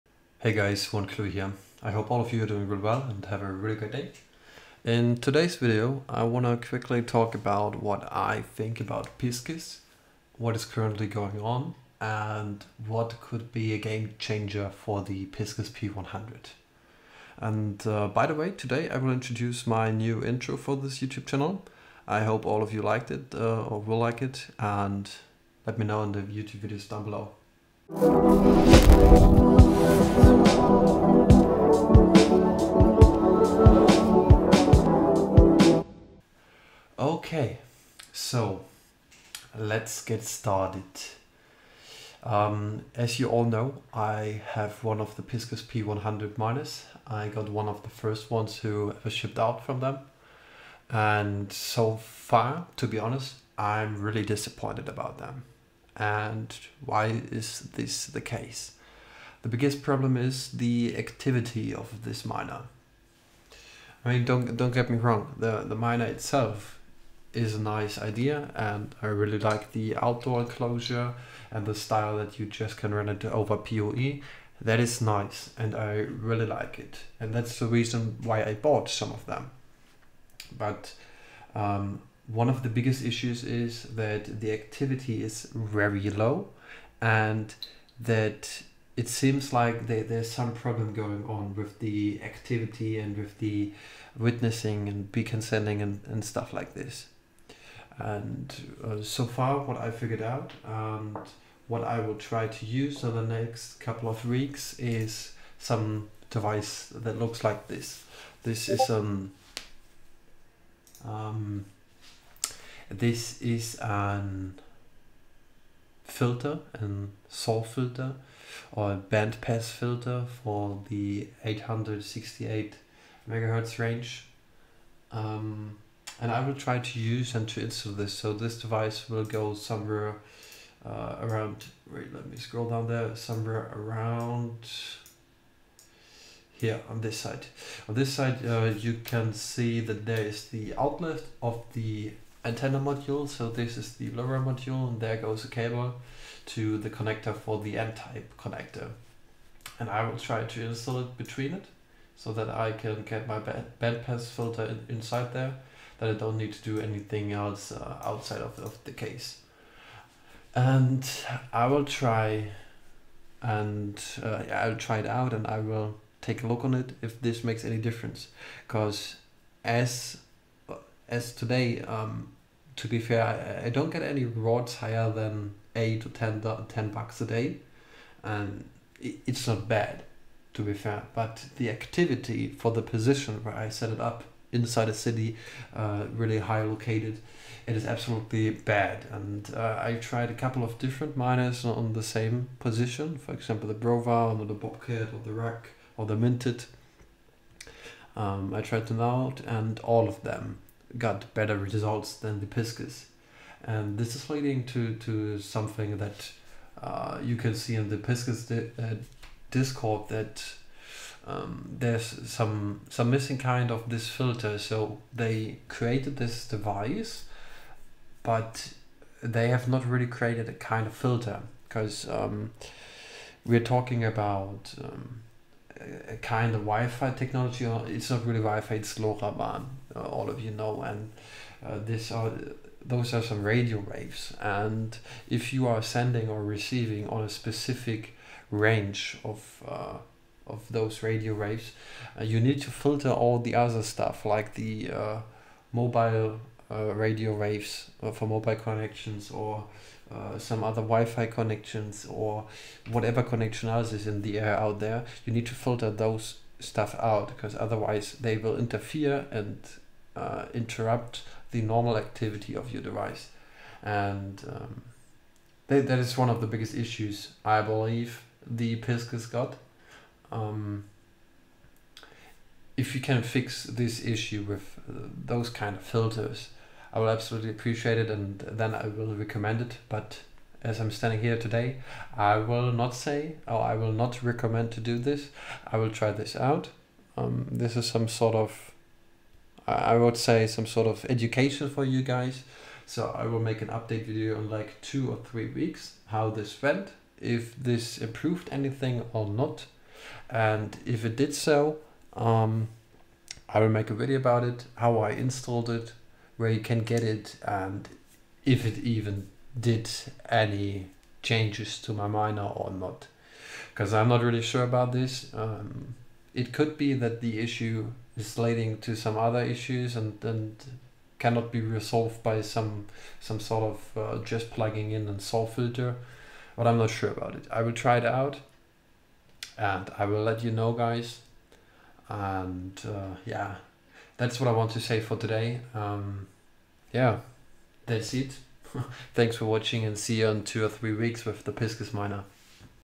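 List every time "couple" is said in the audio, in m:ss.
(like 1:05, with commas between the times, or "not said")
1:43, 3:10.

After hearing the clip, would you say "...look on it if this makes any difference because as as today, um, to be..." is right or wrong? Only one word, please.
right.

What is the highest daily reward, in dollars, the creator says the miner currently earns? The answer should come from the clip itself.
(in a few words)
10.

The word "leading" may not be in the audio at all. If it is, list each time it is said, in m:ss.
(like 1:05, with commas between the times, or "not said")
3:24, 5:18.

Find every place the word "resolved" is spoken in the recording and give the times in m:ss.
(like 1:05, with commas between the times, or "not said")
5:21.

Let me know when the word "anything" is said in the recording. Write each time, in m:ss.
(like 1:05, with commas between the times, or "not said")
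2:36, 4:58.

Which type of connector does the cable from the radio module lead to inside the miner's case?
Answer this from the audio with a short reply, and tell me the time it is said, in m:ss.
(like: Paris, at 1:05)
N-type, at 2:27.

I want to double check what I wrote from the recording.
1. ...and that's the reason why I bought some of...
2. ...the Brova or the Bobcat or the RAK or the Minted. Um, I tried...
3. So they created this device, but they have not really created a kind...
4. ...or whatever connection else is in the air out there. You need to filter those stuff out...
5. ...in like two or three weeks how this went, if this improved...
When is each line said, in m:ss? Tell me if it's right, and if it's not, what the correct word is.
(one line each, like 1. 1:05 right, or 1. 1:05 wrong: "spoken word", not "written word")
1. 1:17 right
2. 3:13 right
3. 3:34 right
4. 4:12 right
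5. 4:54 right.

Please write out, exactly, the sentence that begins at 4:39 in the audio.
But as I'm standing here today, I will not say or I will not recommend to do this.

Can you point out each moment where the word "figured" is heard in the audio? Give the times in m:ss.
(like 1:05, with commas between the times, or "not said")
1:39.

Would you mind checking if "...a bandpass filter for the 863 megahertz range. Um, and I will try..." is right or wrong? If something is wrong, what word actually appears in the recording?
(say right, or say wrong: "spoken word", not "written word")
wrong: "868", not "863".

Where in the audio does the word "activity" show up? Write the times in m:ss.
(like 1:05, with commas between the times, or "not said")
1:00, 1:24, 1:32, 3:01, 4:21.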